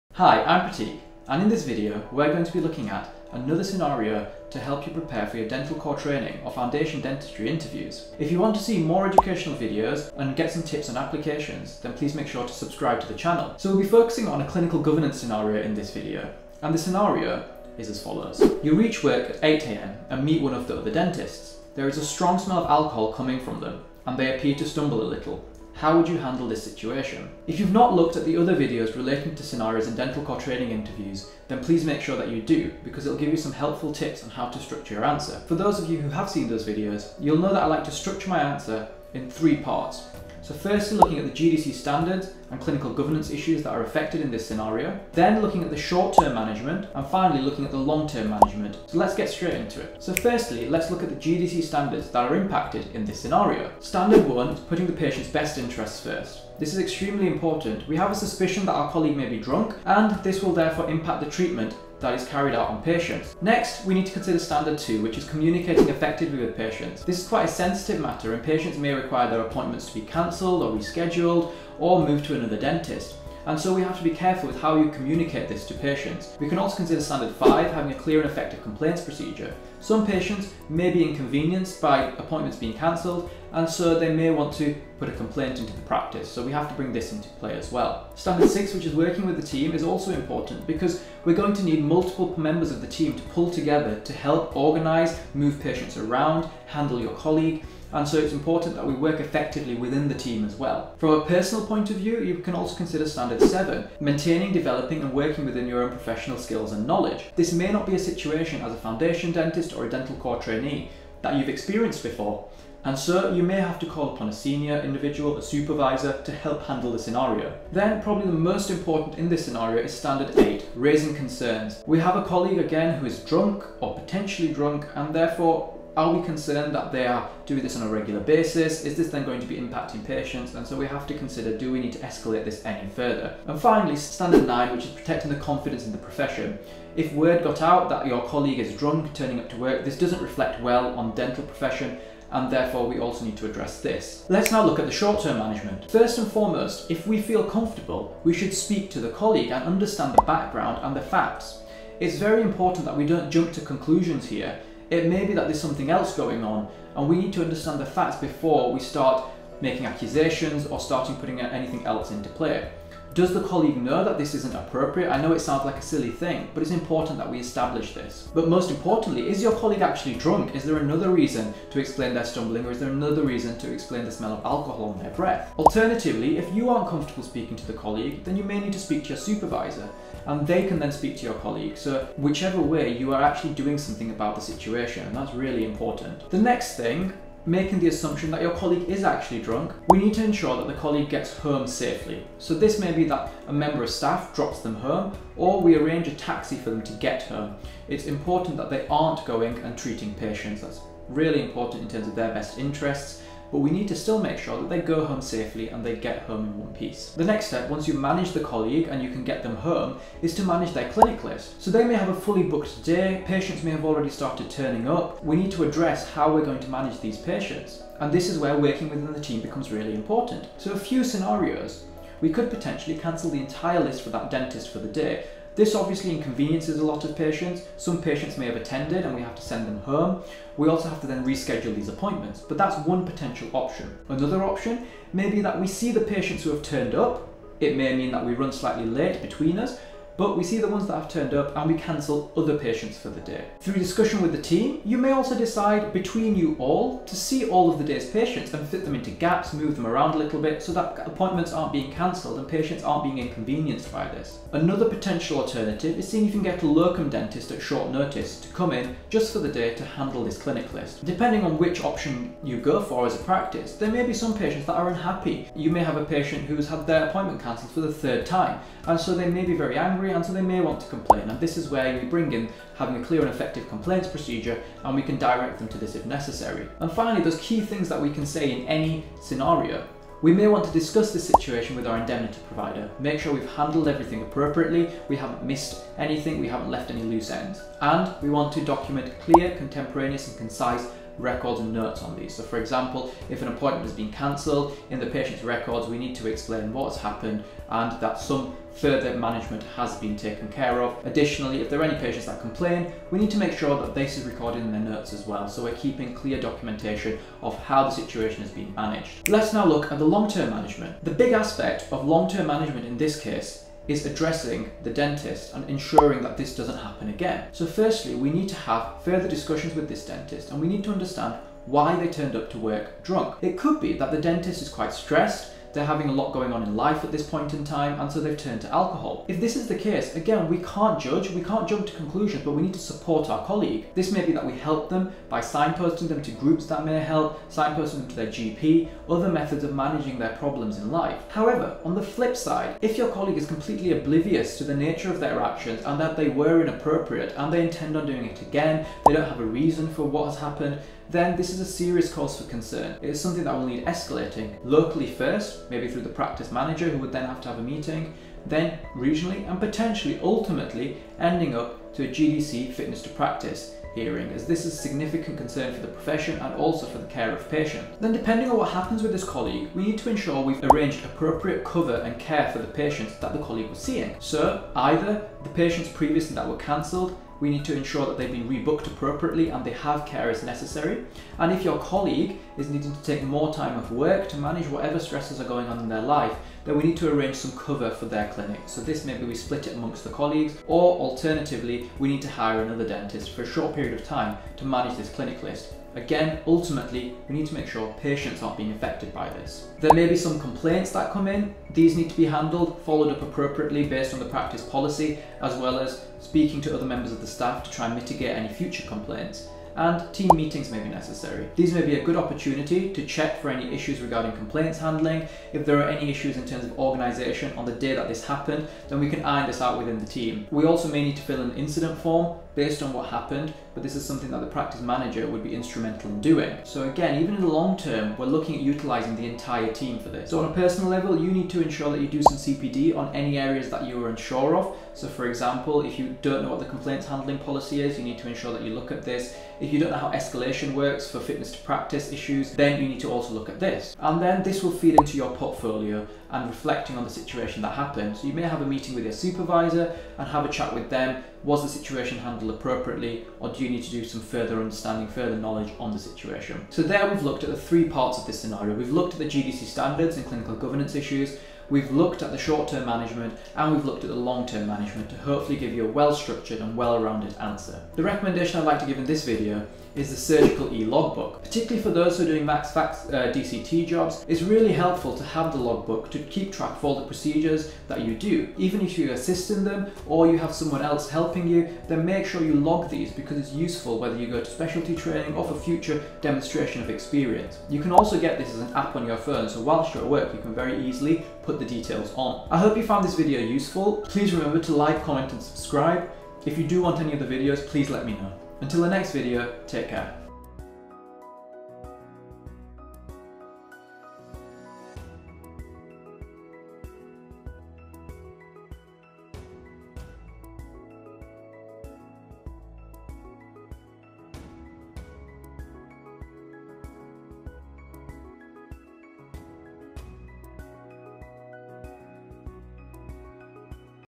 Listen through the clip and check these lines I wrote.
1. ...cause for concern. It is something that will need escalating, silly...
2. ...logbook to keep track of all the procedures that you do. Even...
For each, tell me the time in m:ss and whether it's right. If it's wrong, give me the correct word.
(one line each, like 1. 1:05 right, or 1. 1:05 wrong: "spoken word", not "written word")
1. 5:52 wrong: "locally", not "silly"
2. 7:55 right.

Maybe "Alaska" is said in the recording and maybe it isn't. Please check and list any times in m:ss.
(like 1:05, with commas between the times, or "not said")
not said.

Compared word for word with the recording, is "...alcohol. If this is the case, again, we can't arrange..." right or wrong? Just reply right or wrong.
wrong.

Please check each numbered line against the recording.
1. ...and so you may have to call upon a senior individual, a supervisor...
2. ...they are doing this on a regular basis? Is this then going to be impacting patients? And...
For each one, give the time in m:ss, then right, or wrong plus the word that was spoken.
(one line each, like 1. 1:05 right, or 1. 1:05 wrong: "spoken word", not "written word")
1. 1:52 right
2. 2:06 right.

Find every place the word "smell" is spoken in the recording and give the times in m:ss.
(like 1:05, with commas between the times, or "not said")
0:22, 2:54.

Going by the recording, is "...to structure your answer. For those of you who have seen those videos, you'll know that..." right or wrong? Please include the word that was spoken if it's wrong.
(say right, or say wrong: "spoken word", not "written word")
right.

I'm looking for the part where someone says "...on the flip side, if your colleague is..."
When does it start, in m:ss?
5:41.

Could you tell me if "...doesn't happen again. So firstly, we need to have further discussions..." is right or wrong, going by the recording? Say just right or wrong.
right.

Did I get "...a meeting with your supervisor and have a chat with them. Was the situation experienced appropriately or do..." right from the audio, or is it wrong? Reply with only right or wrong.
wrong.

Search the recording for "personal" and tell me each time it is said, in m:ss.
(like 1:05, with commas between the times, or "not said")
1:41, 7:10.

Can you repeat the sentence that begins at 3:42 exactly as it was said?
We could potentially cancel the entire list for that dentist for the day this obviously inconveniences a lot of patients.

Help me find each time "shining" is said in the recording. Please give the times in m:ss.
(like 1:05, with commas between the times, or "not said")
not said.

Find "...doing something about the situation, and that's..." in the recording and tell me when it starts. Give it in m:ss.
3:03.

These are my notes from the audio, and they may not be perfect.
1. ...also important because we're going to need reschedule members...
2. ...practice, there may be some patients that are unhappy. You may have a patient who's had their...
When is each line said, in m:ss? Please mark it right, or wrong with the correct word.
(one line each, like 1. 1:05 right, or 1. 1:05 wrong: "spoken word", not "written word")
1. 1:29 wrong: "multiple", not "reschedule"
2. 4:23 right.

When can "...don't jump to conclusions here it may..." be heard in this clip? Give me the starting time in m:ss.
2:33.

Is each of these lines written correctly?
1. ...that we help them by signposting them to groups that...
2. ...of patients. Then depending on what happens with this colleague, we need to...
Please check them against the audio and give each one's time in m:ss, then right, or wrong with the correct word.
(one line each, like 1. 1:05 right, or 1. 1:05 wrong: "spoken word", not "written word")
1. 5:34 right
2. 6:07 right.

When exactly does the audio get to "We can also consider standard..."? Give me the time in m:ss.
1:16.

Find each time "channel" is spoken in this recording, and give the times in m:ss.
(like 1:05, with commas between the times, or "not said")
0:13.